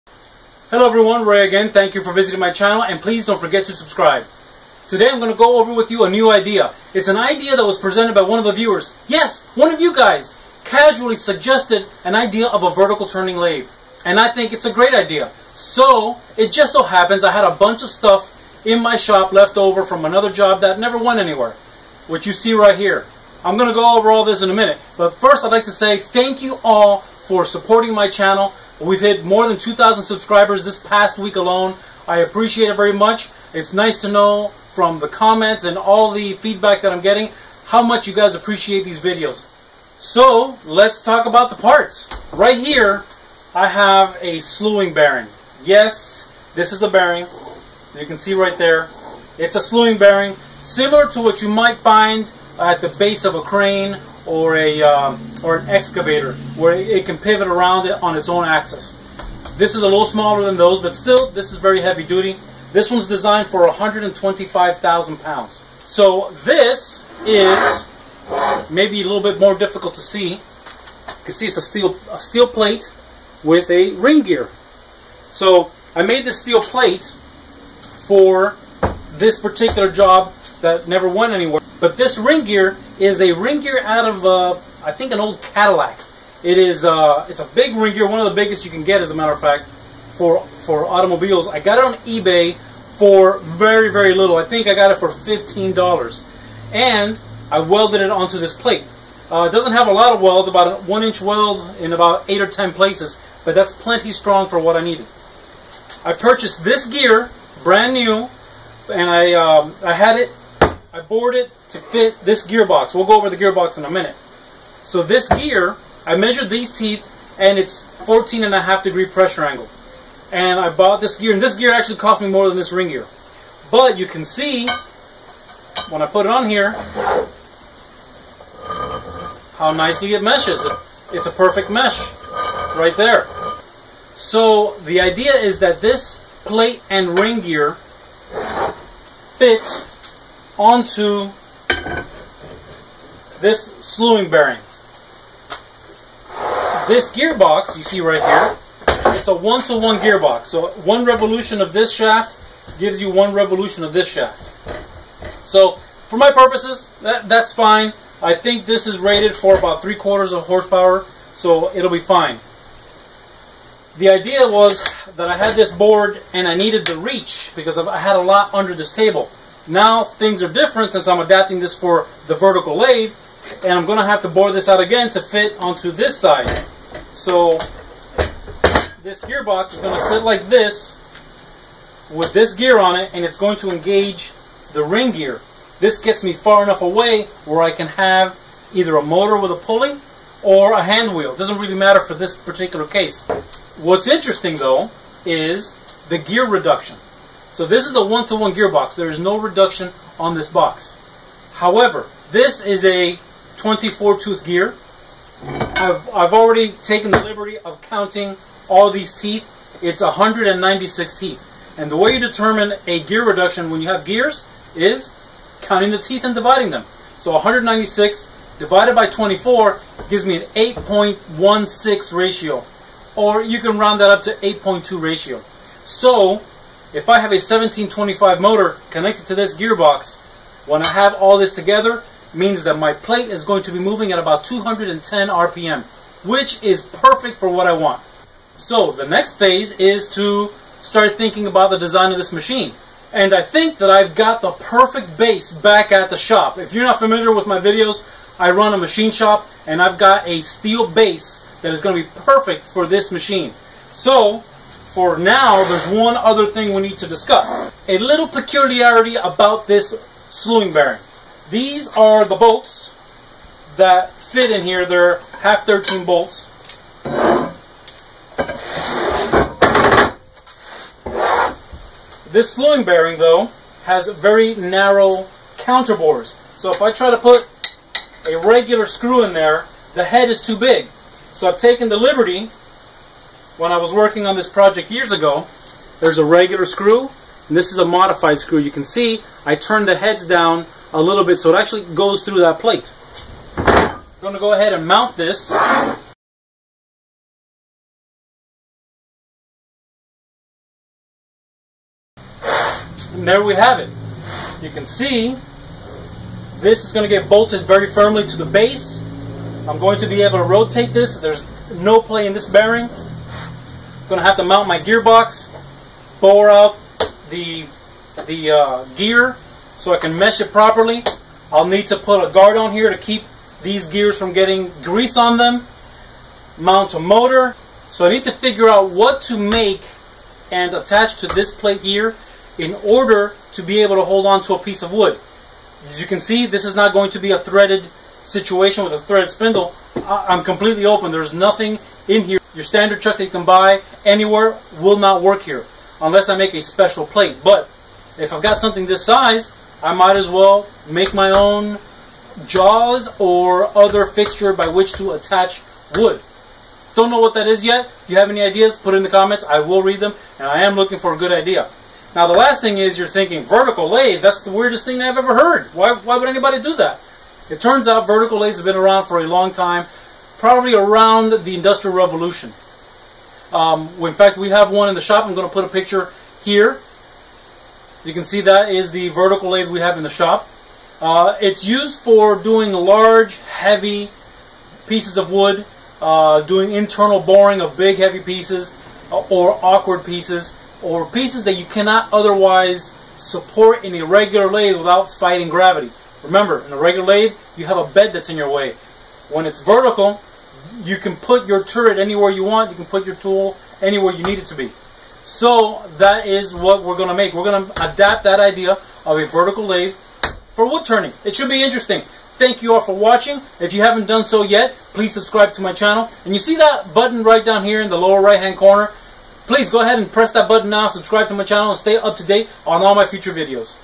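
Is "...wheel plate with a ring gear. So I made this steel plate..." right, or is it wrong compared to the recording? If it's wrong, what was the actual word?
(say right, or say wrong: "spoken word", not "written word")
wrong: "steel", not "wheel".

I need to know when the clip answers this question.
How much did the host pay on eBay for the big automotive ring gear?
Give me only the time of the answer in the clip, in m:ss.
1:35.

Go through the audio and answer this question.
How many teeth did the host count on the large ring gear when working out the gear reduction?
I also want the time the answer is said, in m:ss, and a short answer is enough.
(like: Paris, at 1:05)
196, at 3:30.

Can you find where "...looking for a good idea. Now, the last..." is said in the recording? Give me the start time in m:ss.
6:00.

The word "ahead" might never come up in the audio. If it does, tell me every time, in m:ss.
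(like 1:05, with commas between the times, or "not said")
4:54, 6:59.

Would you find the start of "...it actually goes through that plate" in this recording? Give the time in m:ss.
4:51.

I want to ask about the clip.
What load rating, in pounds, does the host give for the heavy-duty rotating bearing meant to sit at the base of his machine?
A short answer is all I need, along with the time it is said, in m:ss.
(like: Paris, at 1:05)
125,000 pounds, at 1:03.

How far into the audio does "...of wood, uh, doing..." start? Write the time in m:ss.
6:25.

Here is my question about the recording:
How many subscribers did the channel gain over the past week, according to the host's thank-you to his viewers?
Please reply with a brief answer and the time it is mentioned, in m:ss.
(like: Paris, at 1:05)
more than 2,000, at 0:29.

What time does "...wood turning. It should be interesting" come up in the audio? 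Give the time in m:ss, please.
6:50.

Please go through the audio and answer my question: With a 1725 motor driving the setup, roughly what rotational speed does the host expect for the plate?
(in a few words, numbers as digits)
210 RPM.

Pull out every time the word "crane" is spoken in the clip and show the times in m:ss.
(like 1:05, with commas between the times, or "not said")
0:53.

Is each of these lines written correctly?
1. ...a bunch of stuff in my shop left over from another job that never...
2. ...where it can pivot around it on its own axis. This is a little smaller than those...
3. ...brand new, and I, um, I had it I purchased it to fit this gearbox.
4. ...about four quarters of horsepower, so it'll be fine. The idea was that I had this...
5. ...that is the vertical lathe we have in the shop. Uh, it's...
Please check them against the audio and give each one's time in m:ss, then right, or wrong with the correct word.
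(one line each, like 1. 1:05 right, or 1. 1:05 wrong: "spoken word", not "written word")
1. 0:17 right
2. 0:56 right
3. 1:47 wrong: "bored", not "purchased"
4. 2:39 wrong: "three", not "four"
5. 6:18 right.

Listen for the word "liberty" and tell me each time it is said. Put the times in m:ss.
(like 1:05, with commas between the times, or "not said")
3:27, 4:41.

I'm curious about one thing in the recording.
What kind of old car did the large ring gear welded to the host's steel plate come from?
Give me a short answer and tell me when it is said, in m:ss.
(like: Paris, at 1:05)
Cadillac, at 1:25.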